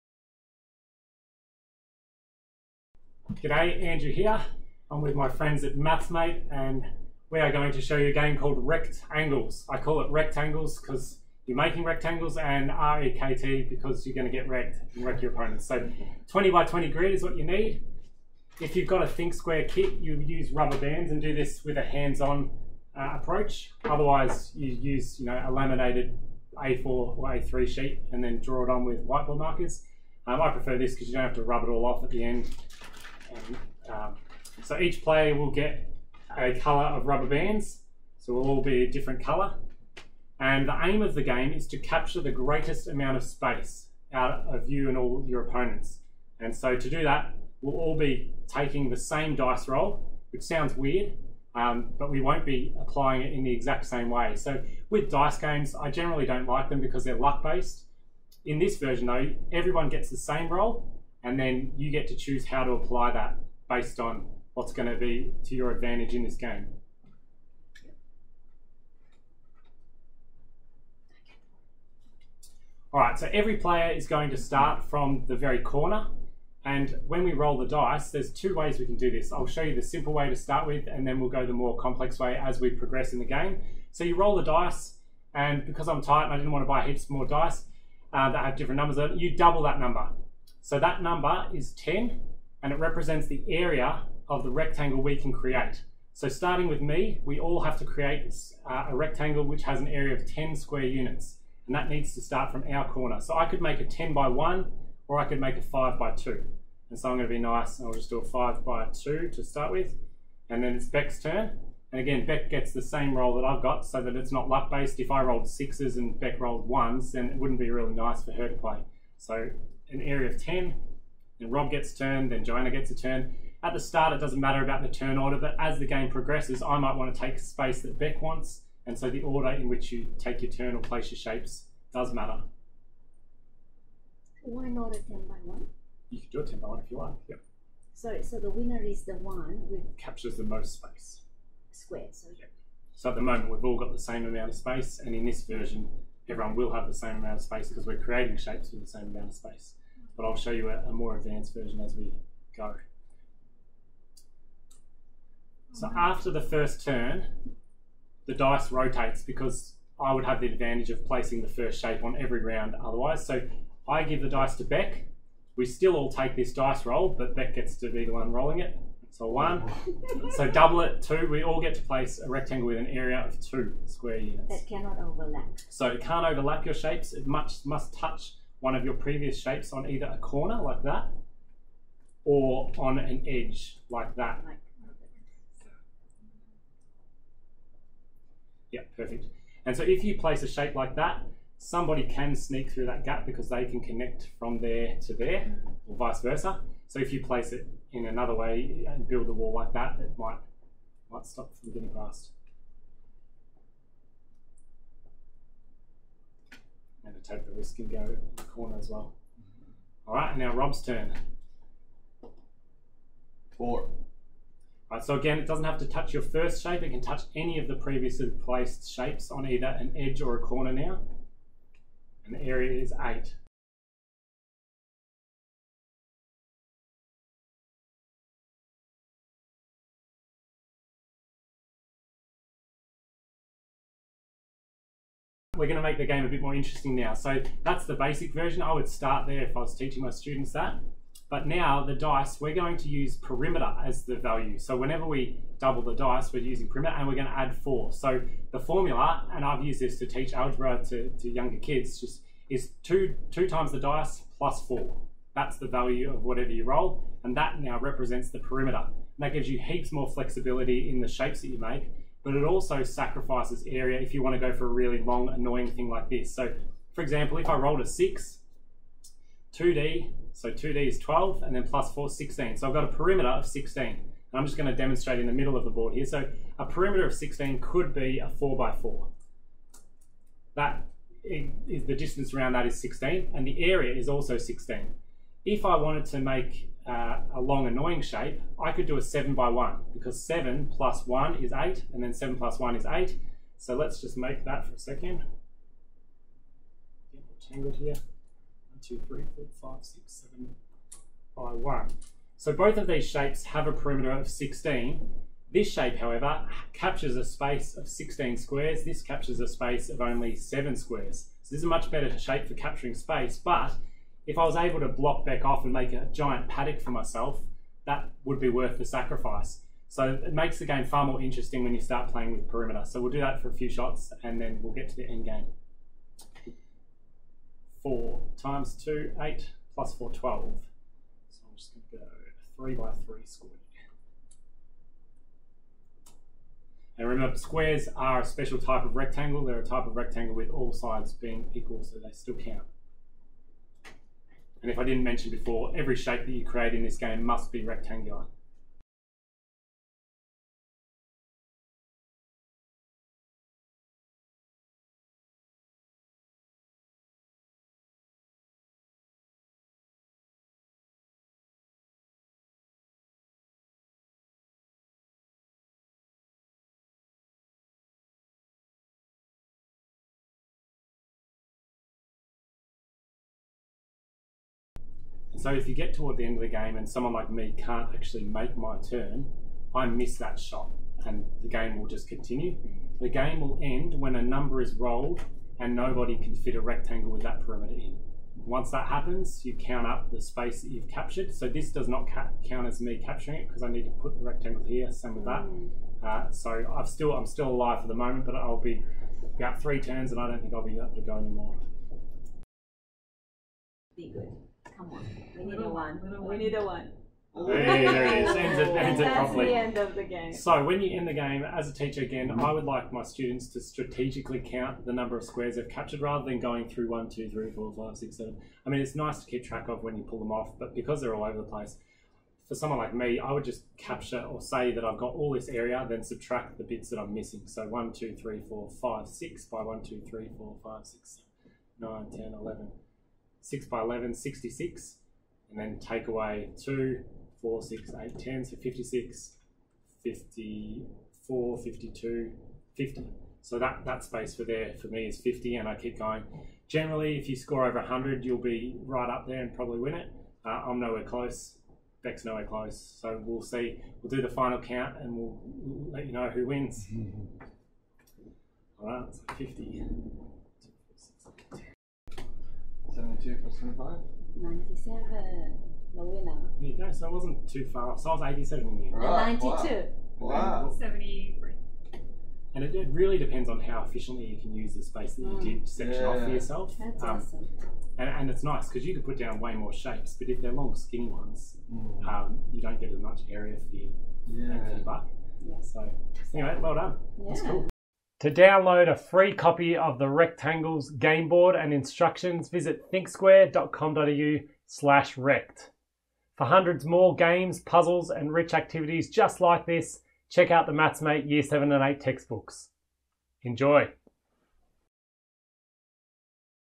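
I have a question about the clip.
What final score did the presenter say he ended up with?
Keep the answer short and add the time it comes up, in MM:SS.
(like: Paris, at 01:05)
87, at 07:48.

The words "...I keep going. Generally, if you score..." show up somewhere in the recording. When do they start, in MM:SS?
07:25.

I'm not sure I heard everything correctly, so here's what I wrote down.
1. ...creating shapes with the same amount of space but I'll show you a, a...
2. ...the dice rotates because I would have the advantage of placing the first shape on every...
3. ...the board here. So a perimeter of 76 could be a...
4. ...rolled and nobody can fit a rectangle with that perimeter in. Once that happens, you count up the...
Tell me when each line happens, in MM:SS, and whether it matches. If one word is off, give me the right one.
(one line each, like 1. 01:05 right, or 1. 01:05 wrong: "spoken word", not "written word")
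1. 02:27 right
2. 02:38 right
3. 04:35 wrong: "16", not "76"
4. 06:24 right.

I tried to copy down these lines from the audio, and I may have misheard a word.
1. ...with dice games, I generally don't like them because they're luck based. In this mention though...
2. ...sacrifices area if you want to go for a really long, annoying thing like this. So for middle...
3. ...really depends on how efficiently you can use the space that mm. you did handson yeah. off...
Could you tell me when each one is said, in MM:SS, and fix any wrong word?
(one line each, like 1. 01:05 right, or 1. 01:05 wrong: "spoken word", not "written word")
1. 00:54 wrong: "version", not "mention"
2. 04:22 wrong: "example", not "middle"
3. 07:52 wrong: "section", not "handson".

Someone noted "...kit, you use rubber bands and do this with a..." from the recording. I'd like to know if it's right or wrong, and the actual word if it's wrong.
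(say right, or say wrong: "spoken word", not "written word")
right.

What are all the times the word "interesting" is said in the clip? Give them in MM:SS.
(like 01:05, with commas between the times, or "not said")
03:56, 05:21.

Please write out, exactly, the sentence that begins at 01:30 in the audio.
So that number is 10 and it represents the area of the rectangle we can create.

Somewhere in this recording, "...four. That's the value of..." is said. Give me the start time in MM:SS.
04:14.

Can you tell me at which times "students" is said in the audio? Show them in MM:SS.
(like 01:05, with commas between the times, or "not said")
04:00, 06:53.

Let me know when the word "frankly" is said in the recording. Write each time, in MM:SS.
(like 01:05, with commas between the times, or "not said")
not said.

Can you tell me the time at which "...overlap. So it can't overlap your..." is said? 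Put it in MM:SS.
02:54.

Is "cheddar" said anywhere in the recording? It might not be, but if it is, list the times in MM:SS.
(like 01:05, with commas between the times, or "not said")
not said.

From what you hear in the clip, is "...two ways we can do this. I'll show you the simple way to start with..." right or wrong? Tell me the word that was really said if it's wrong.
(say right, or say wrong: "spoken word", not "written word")
right.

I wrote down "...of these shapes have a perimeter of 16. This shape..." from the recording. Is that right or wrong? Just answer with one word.
right.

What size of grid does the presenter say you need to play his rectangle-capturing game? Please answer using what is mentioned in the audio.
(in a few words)
20 by 20.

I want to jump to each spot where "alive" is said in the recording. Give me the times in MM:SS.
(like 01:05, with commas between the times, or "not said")
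06:37.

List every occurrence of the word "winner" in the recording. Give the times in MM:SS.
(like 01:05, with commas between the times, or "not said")
02:18, 07:46.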